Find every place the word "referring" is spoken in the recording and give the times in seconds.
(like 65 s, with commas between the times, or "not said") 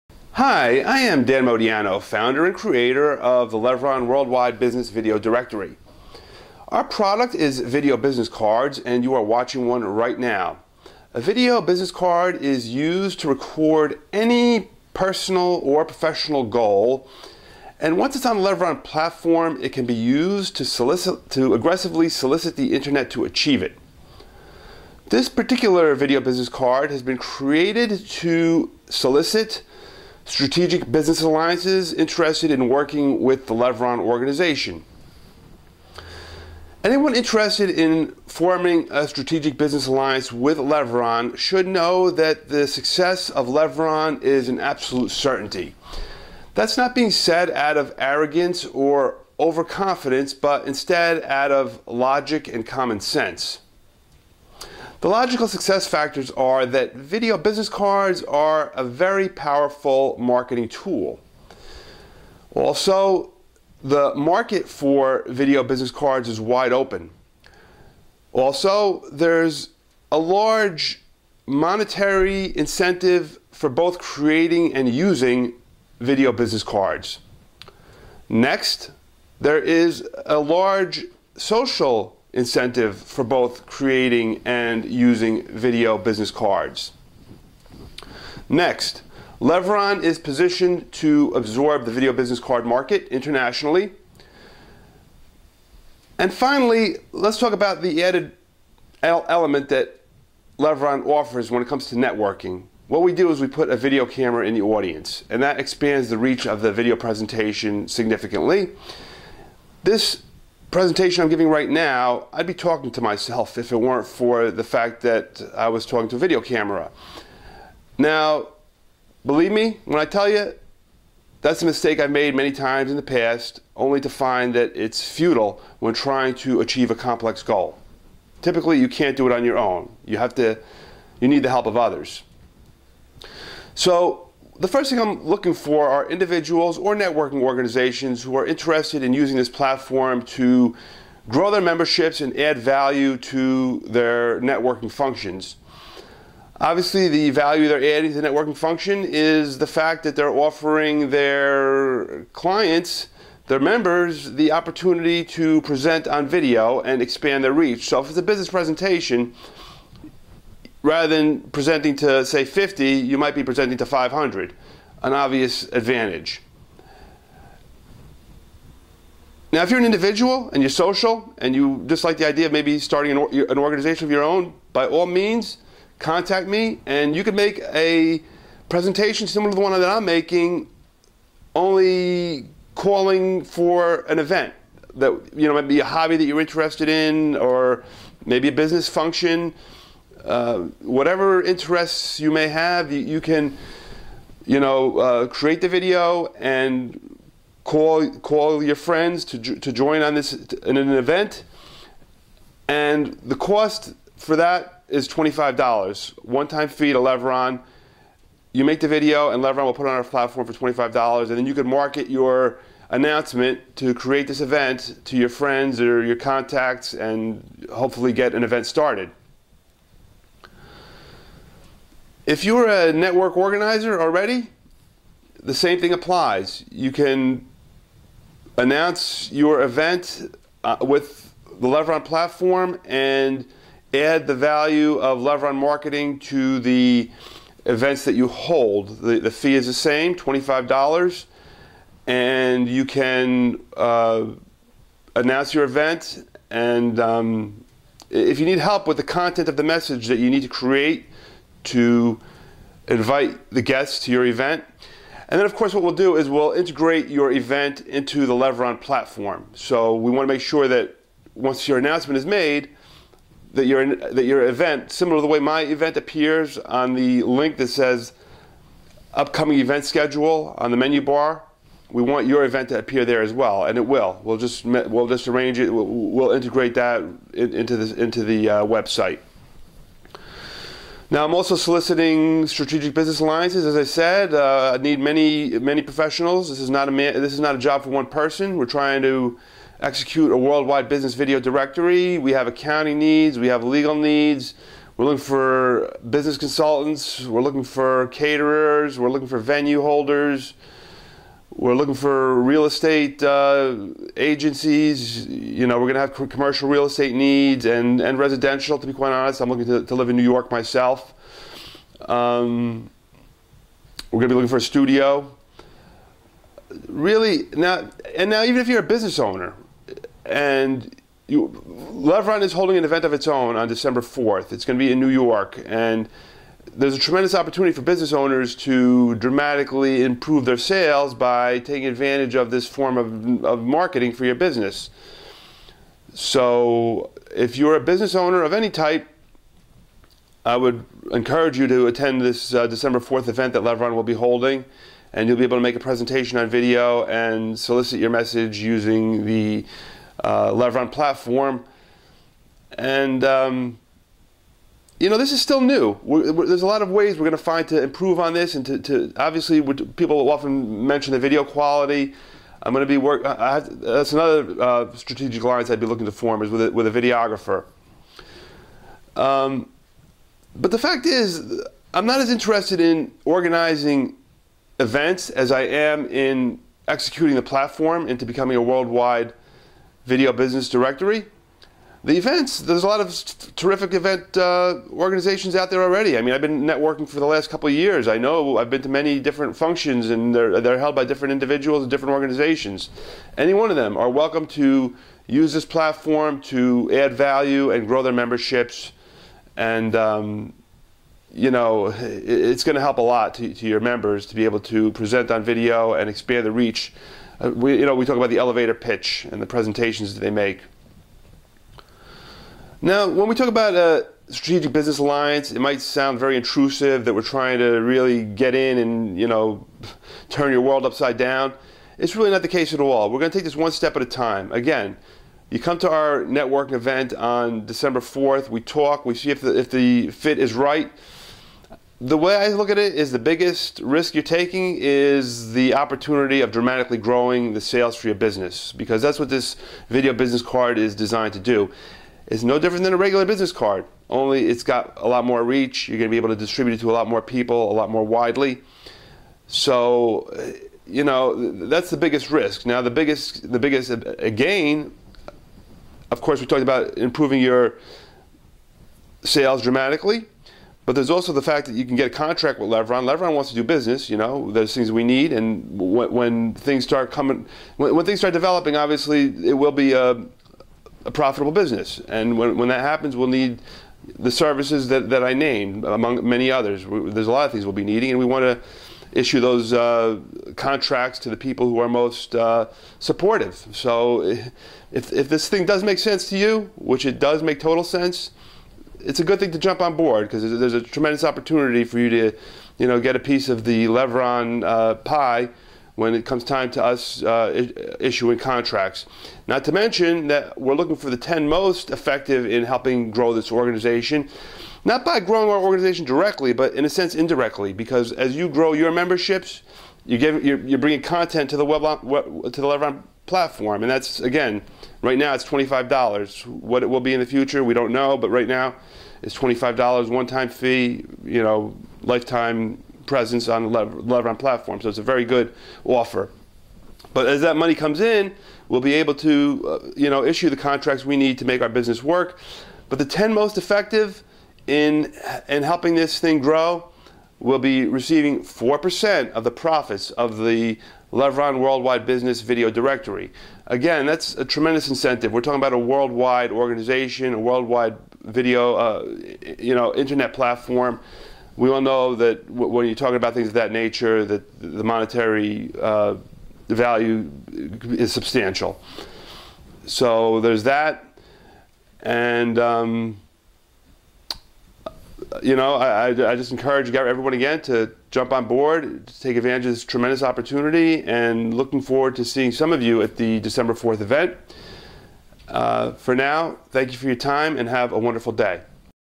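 not said.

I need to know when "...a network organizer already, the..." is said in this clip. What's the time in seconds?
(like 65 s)
222 s.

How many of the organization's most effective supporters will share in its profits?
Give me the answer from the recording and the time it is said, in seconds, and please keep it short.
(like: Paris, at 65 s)
10, at 532 s.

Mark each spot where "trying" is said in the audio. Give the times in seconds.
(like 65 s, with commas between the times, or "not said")
125 s, 288 s, 417 s.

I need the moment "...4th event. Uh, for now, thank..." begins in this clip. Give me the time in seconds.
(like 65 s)
573 s.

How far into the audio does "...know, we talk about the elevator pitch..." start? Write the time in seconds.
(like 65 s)
407 s.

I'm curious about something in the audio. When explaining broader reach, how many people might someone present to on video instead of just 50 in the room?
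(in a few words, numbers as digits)
500.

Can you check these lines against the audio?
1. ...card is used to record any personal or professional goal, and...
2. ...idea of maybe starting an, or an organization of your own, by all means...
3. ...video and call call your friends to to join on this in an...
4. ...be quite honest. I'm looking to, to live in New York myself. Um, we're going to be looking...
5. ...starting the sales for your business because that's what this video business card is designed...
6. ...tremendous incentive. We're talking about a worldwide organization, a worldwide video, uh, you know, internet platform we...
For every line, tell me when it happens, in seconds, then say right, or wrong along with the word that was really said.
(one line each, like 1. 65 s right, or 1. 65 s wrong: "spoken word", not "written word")
1. 11 s right
2. 172 s right
3. 195 s right
4. 308 s right
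5. 436 s wrong: "growing", not "starting"
6. 544 s right.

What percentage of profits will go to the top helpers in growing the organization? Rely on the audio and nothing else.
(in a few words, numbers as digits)
4%.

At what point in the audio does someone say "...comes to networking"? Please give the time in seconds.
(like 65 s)
101 s.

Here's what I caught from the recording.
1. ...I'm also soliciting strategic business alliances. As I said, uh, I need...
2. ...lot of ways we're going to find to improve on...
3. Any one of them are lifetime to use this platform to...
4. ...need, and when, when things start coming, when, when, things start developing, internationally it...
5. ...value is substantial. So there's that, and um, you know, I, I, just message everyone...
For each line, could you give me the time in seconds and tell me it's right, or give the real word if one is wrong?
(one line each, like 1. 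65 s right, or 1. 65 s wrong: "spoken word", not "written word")
1. 281 s right
2. 356 s right
3. 393 s wrong: "welcome", not "lifetime"
4. 465 s wrong: "obviously", not "internationally"
5. 556 s wrong: "encourage", not "message".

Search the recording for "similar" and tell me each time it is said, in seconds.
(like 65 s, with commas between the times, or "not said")
179 s, 264 s.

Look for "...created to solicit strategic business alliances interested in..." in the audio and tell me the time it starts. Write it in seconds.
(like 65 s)
27 s.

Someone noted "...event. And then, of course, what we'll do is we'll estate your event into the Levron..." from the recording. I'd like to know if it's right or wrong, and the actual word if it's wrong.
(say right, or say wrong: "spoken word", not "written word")
wrong: "integrate", not "estate".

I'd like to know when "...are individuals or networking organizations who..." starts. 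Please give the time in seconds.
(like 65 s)
135 s.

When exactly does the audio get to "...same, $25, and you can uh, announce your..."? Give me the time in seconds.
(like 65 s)
239 s.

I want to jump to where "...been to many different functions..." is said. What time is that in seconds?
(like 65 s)
388 s.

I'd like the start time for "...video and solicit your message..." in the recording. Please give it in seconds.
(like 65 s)
346 s.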